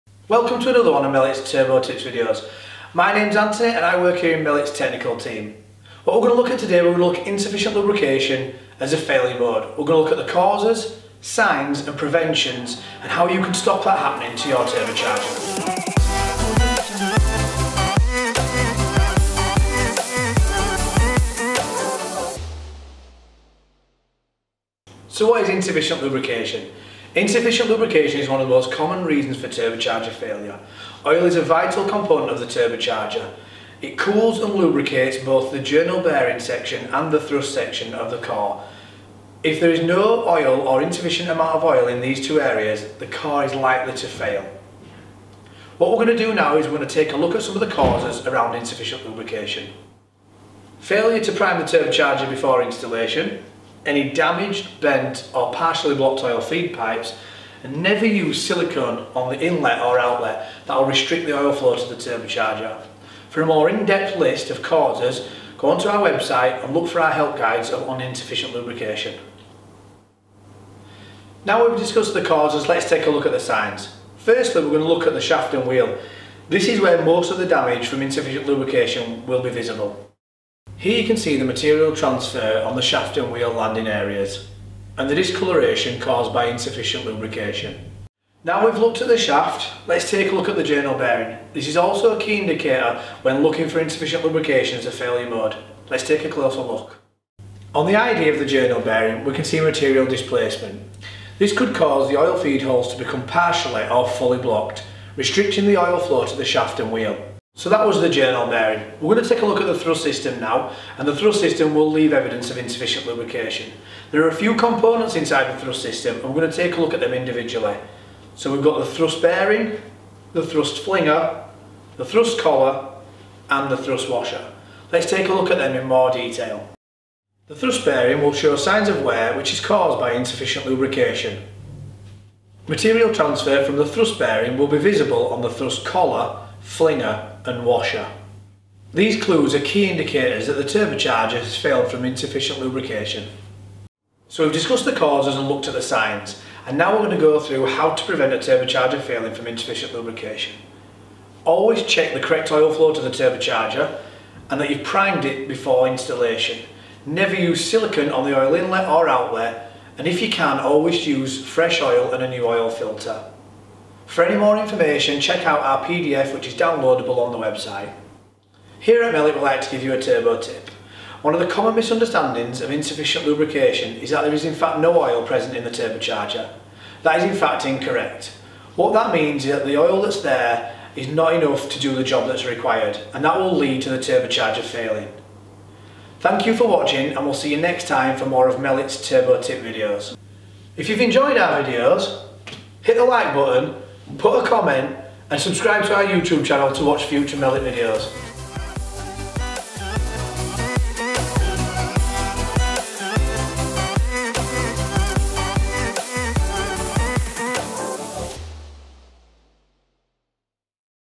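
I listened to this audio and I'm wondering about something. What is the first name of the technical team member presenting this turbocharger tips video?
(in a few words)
Antony.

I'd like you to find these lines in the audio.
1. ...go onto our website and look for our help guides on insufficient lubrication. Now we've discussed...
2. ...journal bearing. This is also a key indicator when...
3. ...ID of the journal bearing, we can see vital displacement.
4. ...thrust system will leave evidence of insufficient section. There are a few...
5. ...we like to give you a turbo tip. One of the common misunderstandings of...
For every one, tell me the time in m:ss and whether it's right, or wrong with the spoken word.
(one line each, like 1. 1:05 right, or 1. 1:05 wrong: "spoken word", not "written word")
1. 1:05 right
2. 1:30 right
3. 1:37 wrong: "material", not "vital"
4. 1:51 wrong: "lubrication", not "section"
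5. 2:49 right.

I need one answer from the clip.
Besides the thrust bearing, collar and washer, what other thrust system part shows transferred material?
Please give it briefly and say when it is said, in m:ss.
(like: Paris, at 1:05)
thrust flinger, at 2:00.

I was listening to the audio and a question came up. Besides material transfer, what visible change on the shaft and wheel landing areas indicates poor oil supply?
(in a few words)
discoloration.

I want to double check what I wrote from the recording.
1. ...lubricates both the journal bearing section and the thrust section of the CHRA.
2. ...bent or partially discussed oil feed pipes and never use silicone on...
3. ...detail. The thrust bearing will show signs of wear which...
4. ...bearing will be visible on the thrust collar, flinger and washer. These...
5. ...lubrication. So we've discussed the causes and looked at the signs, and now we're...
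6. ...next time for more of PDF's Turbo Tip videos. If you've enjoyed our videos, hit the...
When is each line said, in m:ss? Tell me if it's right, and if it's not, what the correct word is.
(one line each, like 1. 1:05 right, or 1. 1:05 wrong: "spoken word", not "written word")
1. 0:34 right
2. 0:54 wrong: "blocked", not "discussed"
3. 2:06 right
4. 2:14 right
5. 2:22 right
6. 3:07 wrong: "Melett", not "PDF".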